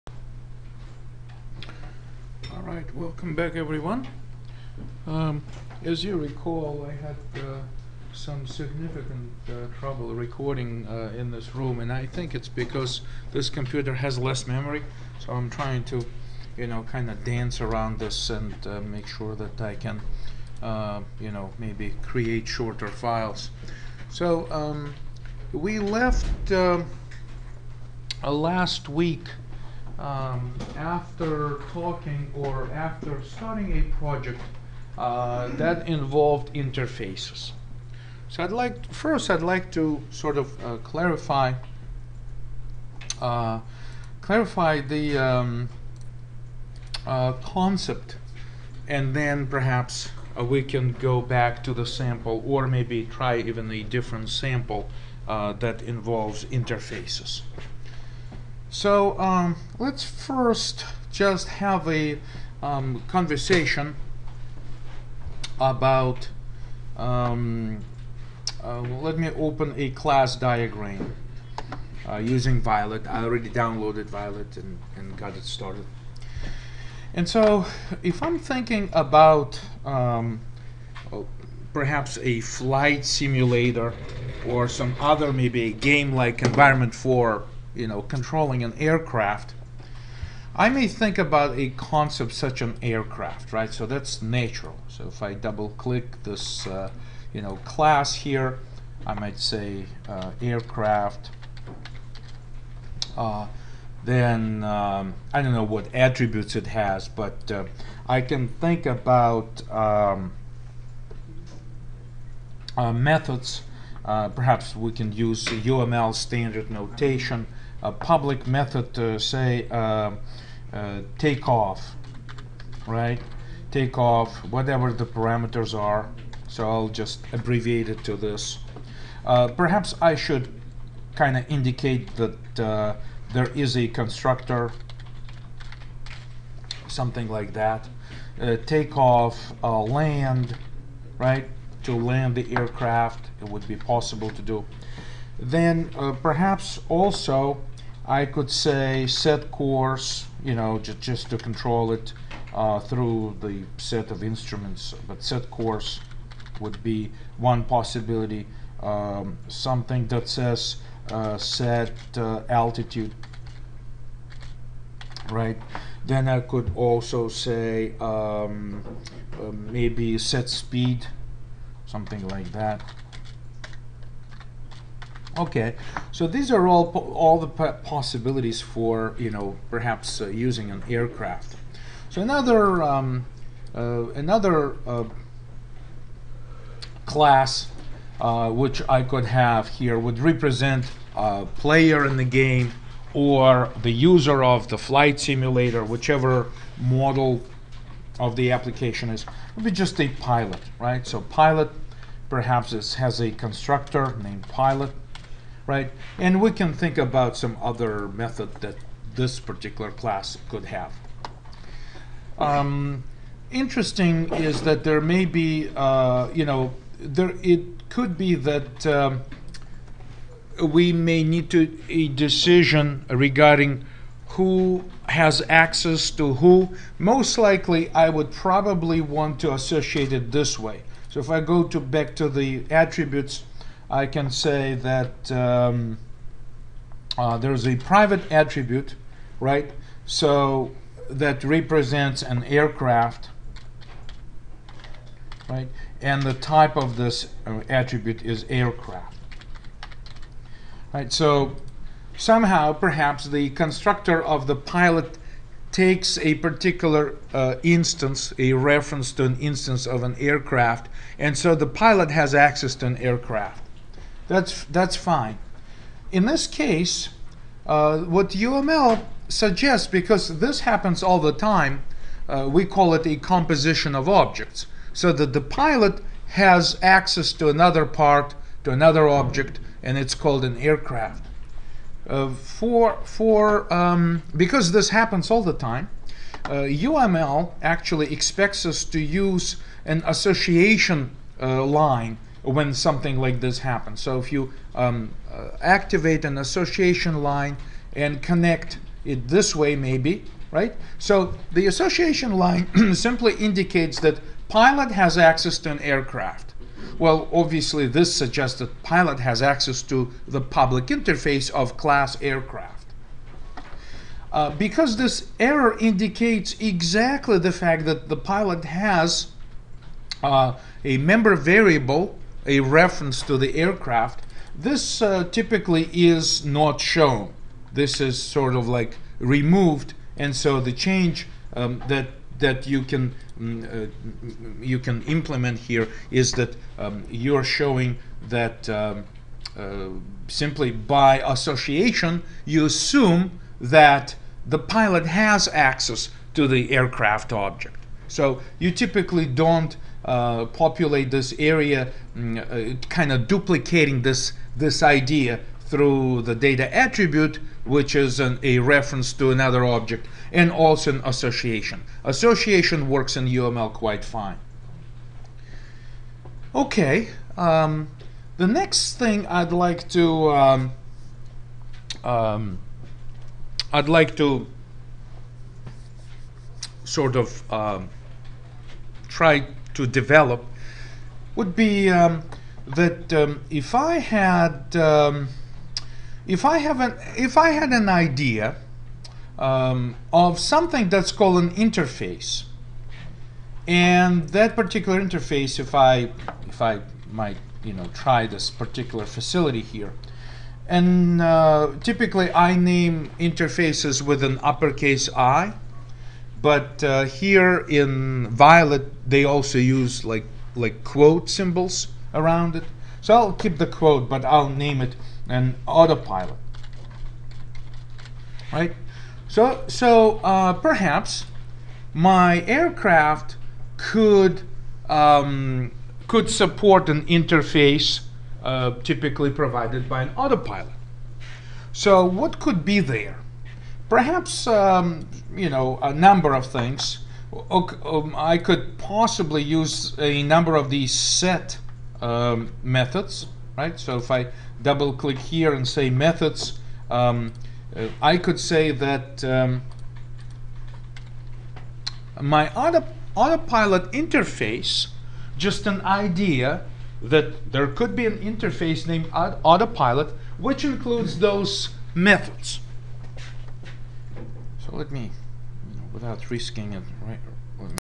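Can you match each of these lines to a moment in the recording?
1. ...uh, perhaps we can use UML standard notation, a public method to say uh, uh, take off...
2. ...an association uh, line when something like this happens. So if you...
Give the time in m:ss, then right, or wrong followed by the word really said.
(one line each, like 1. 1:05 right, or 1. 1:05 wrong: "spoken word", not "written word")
1. 1:54 right
2. 4:49 right.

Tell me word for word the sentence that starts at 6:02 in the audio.
Association works in UML quite fine.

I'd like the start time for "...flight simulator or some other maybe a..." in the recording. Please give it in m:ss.
1:22.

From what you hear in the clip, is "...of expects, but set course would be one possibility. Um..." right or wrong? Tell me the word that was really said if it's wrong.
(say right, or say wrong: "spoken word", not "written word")
wrong: "instruments", not "expects".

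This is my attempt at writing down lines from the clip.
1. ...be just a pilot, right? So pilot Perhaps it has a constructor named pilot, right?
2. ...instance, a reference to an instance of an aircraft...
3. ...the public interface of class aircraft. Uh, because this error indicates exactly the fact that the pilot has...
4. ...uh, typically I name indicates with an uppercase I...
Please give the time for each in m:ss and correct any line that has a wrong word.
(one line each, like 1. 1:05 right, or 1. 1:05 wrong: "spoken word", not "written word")
1. 3:19 right
2. 4:17 right
3. 5:10 right
4. 6:41 wrong: "interfaces", not "indicates".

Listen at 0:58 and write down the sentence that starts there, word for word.
So um, let's first just have a um, conversation about, um, uh, let me open a class diagram uh, using Violet.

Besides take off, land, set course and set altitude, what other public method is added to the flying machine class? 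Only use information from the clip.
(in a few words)
Set speed.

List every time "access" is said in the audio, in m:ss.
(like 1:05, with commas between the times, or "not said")
3:45, 4:22, 4:36, 5:05, 5:09, 5:45.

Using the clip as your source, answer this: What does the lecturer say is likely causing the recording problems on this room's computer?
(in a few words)
Less memory.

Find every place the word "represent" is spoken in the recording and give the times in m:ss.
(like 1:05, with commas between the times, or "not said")
3:10, 4:01.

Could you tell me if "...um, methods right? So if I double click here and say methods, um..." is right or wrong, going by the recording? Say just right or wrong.
right.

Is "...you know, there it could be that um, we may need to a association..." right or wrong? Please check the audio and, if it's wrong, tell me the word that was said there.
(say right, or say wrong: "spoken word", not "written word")
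wrong: "decision", not "association".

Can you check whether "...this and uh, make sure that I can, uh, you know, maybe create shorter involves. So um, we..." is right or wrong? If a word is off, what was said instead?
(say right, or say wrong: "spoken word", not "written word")
wrong: "files", not "involves".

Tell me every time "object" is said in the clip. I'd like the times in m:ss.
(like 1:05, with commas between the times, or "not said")
4:34, 4:39, 5:47, 5:59.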